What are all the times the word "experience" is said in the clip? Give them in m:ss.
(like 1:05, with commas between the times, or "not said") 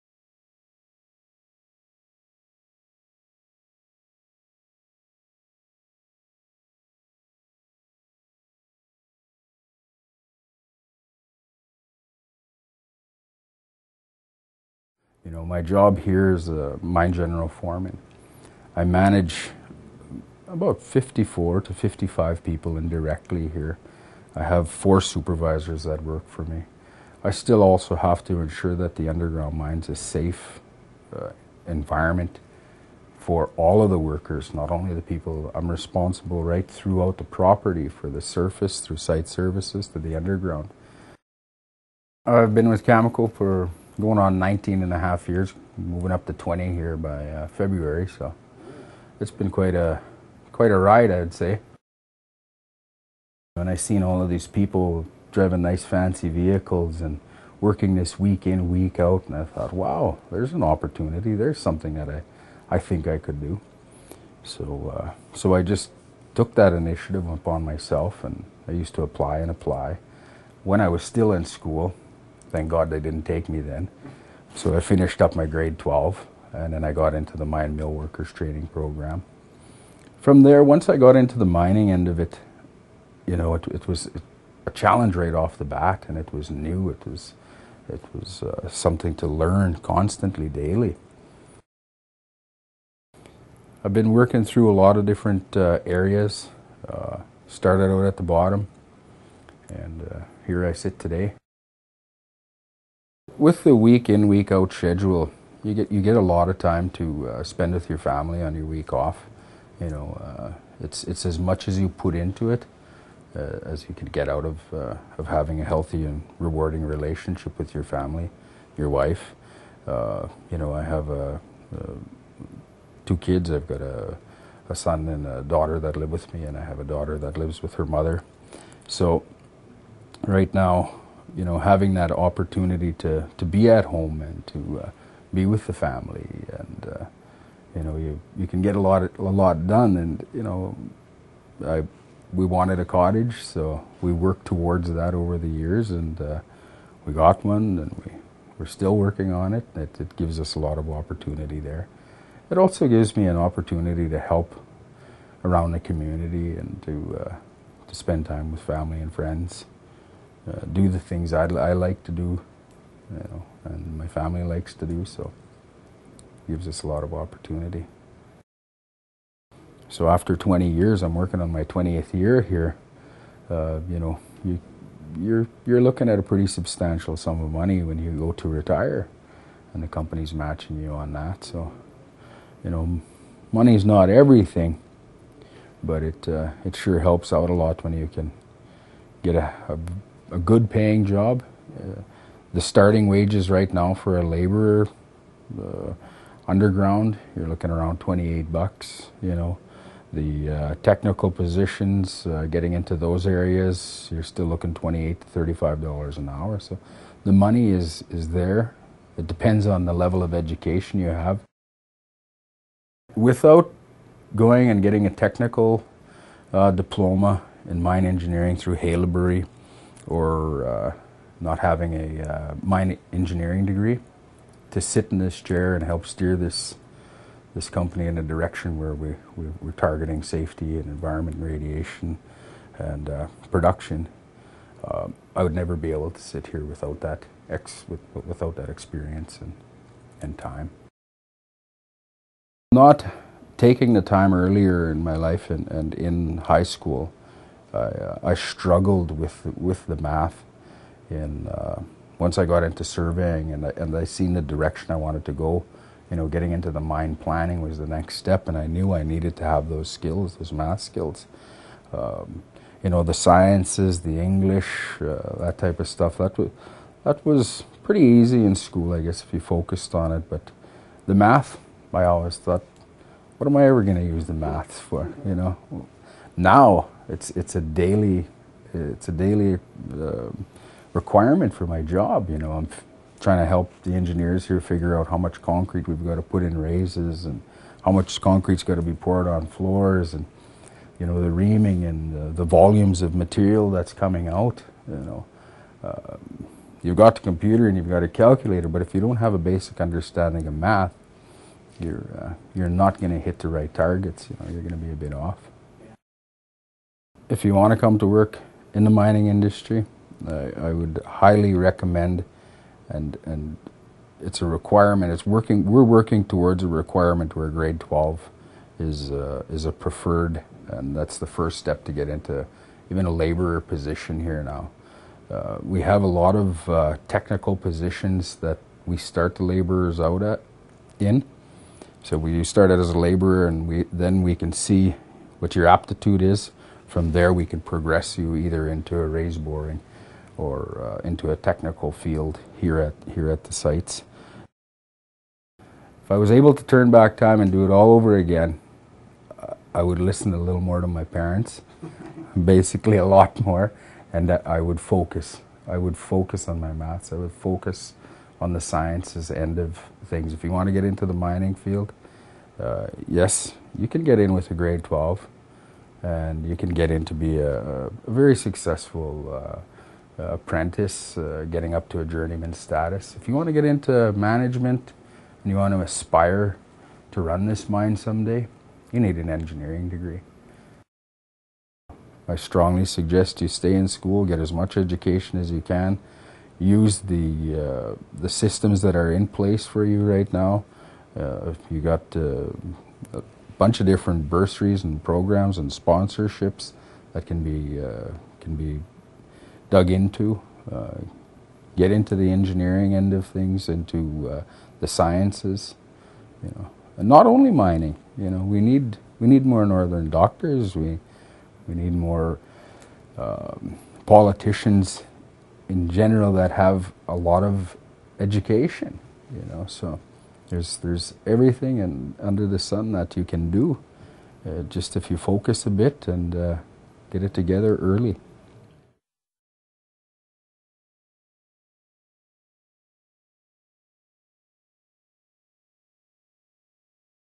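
3:58.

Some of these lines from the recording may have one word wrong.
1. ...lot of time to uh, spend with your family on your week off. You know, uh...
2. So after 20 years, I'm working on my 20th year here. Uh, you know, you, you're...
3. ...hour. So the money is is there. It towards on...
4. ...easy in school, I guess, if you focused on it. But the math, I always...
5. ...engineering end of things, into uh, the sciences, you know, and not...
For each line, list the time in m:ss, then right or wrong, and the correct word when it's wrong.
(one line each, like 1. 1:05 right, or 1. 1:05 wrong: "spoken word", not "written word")
1. 1:46 right
2. 2:49 right
3. 3:26 wrong: "depends", not "towards"
4. 4:28 right
5. 6:42 right.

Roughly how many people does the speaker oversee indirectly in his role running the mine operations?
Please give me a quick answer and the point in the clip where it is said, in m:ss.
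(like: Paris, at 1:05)
54 to 55, at 0:20.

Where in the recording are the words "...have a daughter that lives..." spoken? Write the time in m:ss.
2:06.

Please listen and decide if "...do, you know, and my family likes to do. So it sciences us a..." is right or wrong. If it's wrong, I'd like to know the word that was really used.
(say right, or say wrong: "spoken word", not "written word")
wrong: "gives", not "sciences".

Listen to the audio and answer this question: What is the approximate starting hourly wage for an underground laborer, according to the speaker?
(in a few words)
$28.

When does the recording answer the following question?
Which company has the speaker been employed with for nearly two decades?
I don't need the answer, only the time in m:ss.
0:42.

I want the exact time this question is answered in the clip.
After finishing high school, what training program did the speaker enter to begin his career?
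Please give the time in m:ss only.
1:17.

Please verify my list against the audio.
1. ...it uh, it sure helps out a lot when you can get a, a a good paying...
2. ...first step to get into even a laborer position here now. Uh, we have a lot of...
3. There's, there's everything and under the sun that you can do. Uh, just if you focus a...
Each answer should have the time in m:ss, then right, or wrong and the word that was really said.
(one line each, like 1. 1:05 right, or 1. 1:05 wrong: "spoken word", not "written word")
1. 3:06 right
2. 5:21 right
3. 7:00 right.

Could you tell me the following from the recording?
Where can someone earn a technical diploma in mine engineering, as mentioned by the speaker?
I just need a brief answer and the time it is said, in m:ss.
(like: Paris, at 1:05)
Haileybury, at 3:38.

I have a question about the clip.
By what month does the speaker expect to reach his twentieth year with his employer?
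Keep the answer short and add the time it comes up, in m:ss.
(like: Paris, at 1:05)
February, at 0:47.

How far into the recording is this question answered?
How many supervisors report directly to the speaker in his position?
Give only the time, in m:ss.
0:24.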